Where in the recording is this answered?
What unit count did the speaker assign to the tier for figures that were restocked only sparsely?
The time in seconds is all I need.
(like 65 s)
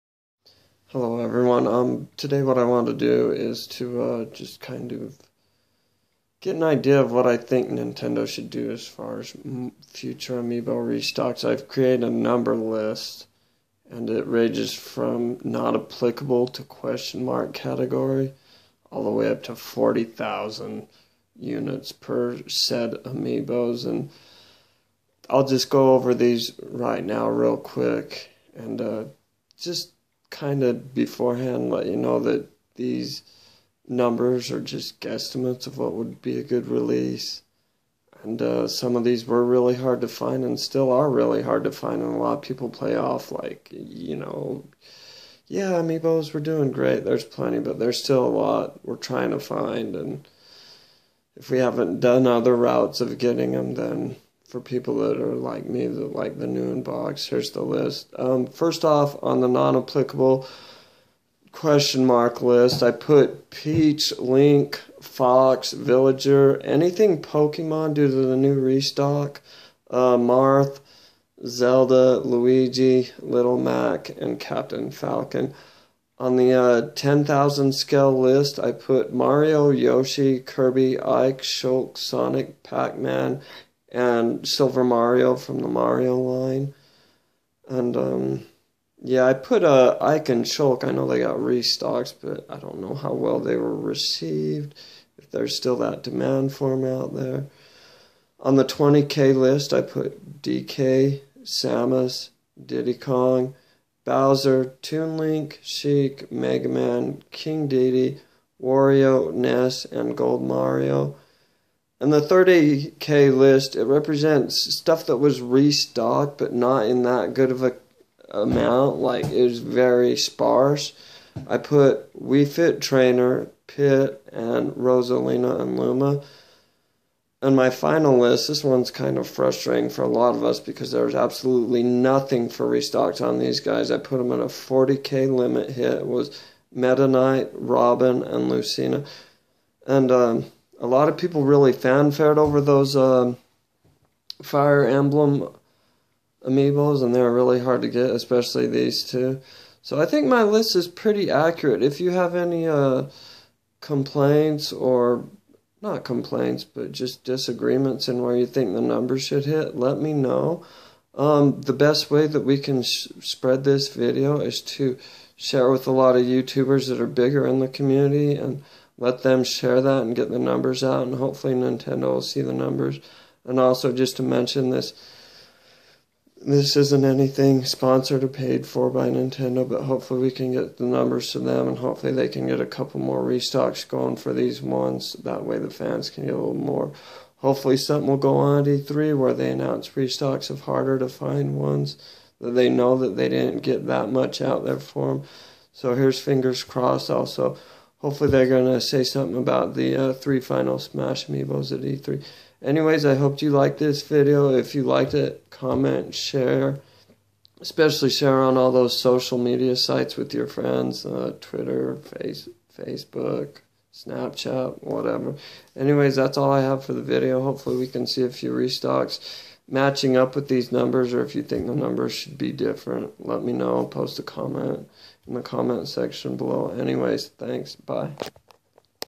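112 s.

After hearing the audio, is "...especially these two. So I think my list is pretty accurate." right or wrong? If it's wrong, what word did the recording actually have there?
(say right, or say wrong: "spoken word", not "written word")
right.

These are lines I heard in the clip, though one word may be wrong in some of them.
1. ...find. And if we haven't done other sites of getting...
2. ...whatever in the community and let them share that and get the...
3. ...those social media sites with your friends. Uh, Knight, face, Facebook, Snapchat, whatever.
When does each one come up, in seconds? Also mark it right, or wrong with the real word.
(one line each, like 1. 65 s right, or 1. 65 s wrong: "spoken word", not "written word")
1. 49 s wrong: "routes", not "sites"
2. 167 s wrong: "bigger", not "whatever"
3. 208 s wrong: "Twitter", not "Knight".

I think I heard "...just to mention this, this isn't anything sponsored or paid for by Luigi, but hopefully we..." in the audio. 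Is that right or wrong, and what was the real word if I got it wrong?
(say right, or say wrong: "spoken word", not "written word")
wrong: "Nintendo", not "Luigi".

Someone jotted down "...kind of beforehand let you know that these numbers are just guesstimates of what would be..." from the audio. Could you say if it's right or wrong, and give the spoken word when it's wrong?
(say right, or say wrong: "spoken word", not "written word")
right.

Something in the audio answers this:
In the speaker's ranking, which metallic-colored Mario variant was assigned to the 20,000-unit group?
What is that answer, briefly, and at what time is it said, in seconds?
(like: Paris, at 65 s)
Gold Mario, at 110 s.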